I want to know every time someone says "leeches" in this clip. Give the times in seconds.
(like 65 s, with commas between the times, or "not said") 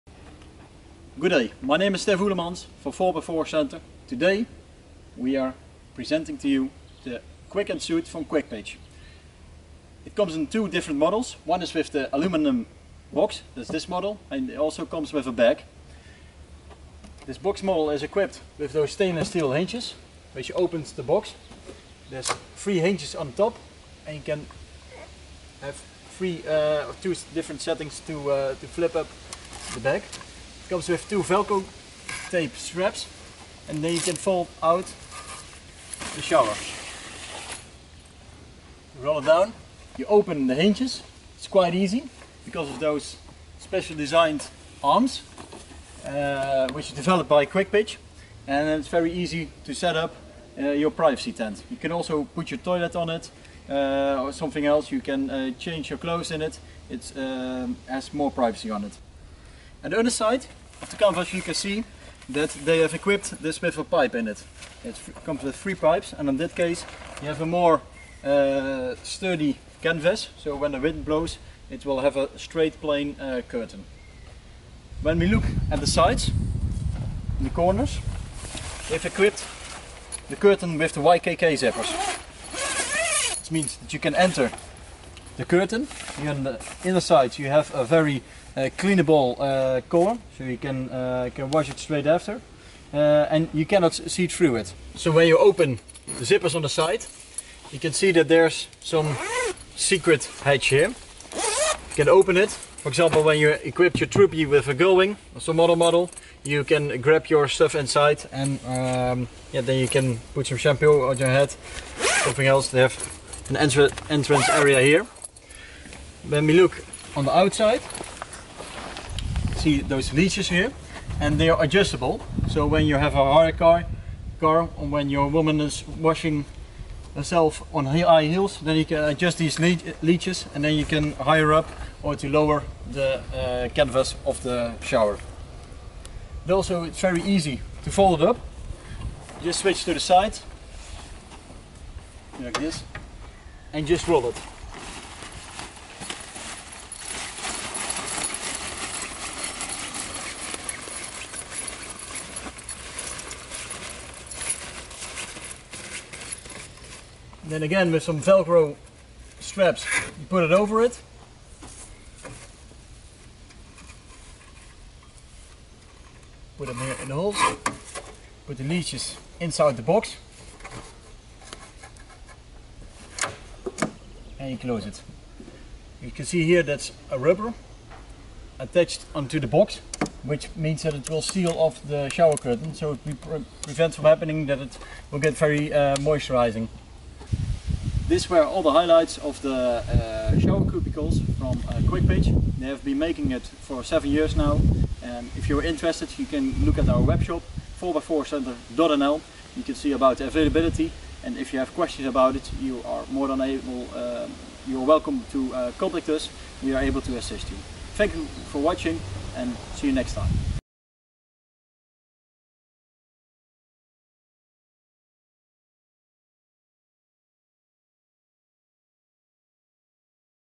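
120 s, 130 s.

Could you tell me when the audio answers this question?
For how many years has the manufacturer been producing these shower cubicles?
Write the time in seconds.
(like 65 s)
193 s.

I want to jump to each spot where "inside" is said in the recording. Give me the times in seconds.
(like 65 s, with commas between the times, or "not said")
107 s, 169 s.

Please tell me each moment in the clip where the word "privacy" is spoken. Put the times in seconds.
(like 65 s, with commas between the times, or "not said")
50 s, 58 s.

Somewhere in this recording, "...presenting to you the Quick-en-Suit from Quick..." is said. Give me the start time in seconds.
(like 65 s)
5 s.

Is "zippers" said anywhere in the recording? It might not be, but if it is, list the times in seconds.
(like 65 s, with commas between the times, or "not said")
81 s, 96 s.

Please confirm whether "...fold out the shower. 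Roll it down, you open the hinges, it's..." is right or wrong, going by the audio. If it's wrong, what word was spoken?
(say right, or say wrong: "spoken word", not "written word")
right.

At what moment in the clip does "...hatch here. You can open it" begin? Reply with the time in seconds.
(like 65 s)
100 s.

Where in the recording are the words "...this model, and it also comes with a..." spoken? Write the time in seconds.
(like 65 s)
13 s.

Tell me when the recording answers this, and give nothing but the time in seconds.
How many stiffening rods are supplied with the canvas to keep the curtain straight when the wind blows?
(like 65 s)
65 s.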